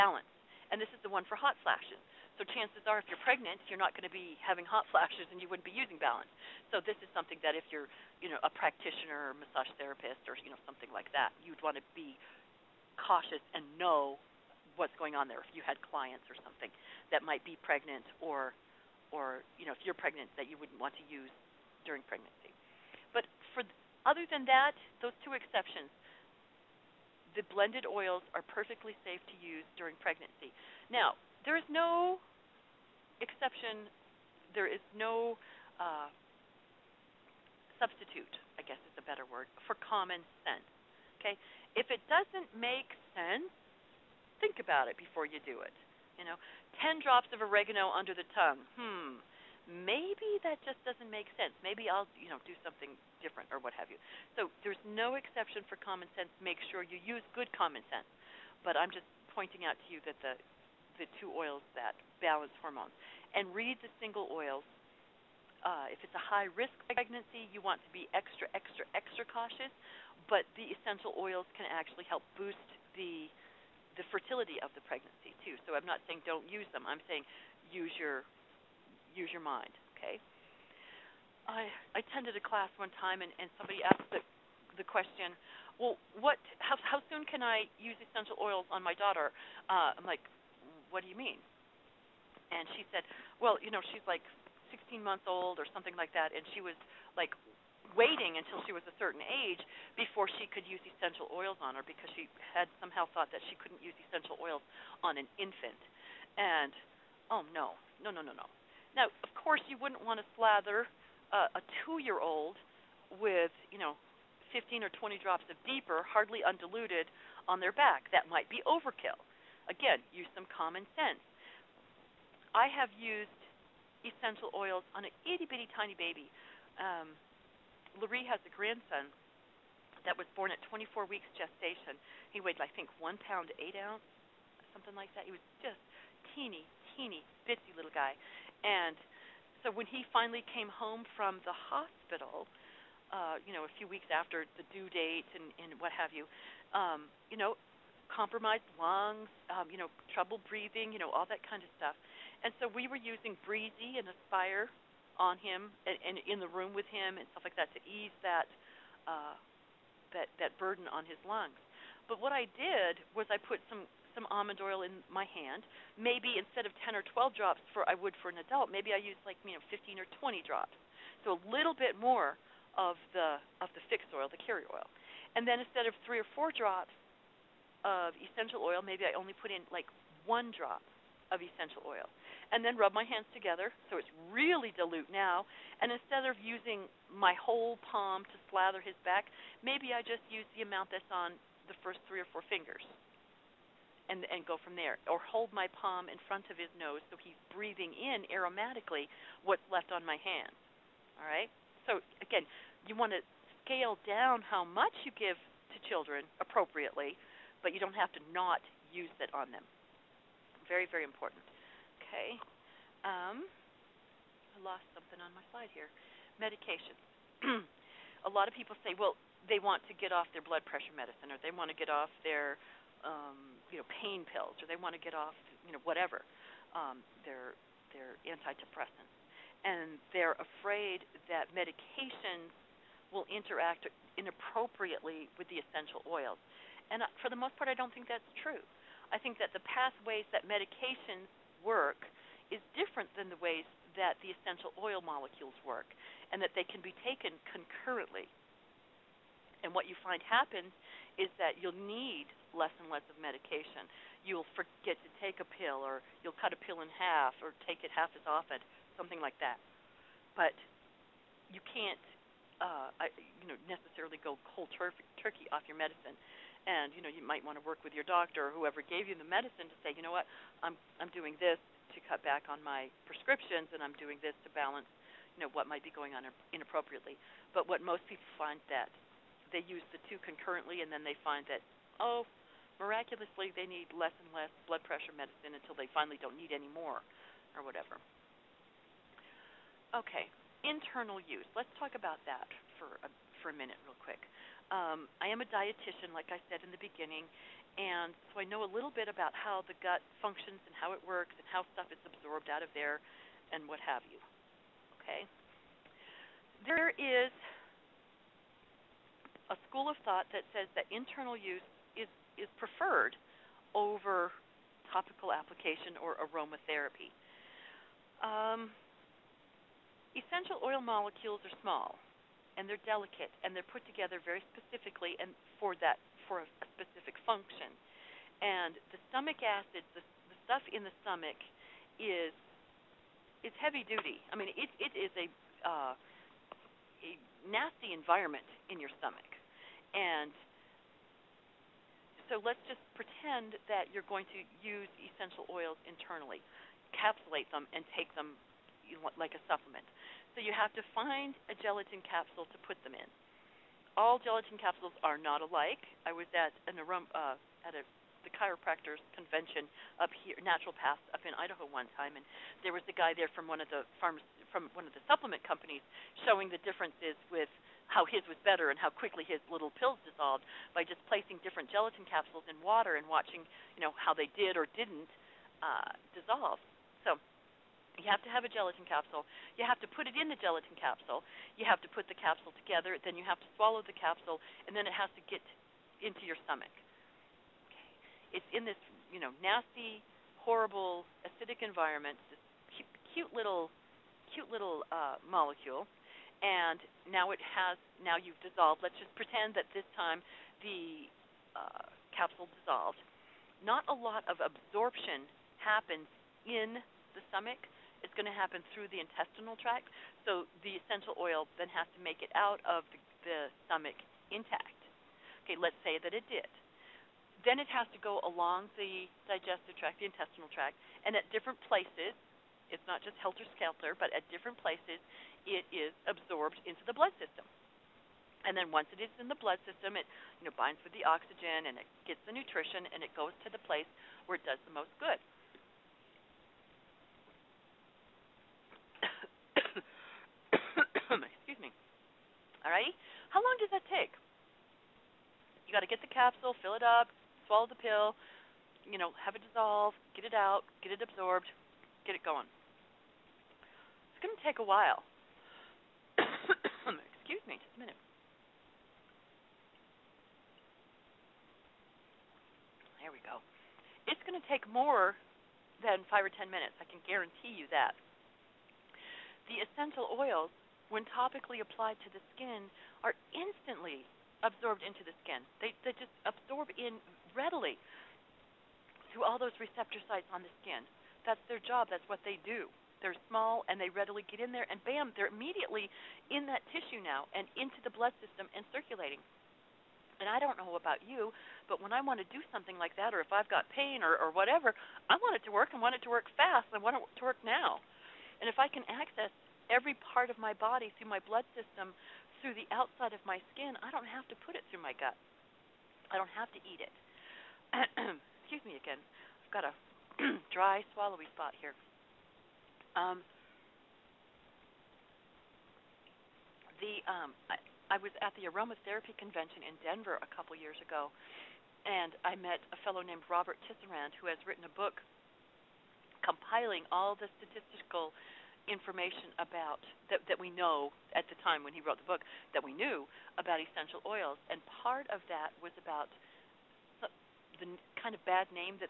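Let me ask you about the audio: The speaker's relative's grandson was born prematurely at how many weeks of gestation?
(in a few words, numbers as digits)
24 weeks.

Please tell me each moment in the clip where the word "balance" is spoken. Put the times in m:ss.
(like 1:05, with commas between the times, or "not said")
0:05, 1:02, 4:34.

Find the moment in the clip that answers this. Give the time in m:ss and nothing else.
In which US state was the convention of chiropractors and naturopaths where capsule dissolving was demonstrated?
6:01.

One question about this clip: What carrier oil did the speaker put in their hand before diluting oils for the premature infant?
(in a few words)
Almond oil.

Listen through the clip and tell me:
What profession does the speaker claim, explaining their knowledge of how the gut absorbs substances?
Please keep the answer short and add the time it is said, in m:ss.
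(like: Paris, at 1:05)
Dietitian, at 4:55.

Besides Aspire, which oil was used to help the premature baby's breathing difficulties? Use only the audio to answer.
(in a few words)
Breezy.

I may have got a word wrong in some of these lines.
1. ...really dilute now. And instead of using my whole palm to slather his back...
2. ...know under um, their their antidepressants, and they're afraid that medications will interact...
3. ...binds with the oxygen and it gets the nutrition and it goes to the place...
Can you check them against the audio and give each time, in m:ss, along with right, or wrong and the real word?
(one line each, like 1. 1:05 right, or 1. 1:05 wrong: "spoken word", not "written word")
1. 3:04 right
2. 3:45 wrong: "whatever", not "under"
3. 7:10 right.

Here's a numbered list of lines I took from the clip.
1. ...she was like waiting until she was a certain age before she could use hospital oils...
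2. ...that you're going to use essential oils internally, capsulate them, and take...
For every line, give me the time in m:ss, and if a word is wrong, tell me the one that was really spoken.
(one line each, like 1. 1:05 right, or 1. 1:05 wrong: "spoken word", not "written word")
1. 1:36 wrong: "essential", not "hospital"
2. 5:43 right.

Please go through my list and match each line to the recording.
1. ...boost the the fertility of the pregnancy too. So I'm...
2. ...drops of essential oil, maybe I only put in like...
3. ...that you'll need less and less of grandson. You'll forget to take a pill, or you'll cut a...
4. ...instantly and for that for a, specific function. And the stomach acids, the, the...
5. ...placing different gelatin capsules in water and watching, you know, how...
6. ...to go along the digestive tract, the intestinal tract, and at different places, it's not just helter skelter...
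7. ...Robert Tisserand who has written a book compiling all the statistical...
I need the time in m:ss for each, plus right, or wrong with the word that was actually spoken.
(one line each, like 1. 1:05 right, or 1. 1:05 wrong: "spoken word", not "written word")
1. 1:12 right
2. 2:56 right
3. 4:11 wrong: "medication", not "grandson"
4. 5:24 wrong: "specifically", not "instantly"
5. 6:11 right
6. 6:57 right
7. 8:43 right.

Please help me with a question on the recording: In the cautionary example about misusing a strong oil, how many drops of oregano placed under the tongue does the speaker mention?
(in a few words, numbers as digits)
10.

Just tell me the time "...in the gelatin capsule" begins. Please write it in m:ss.
6:20.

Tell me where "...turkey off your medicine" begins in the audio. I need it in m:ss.
4:25.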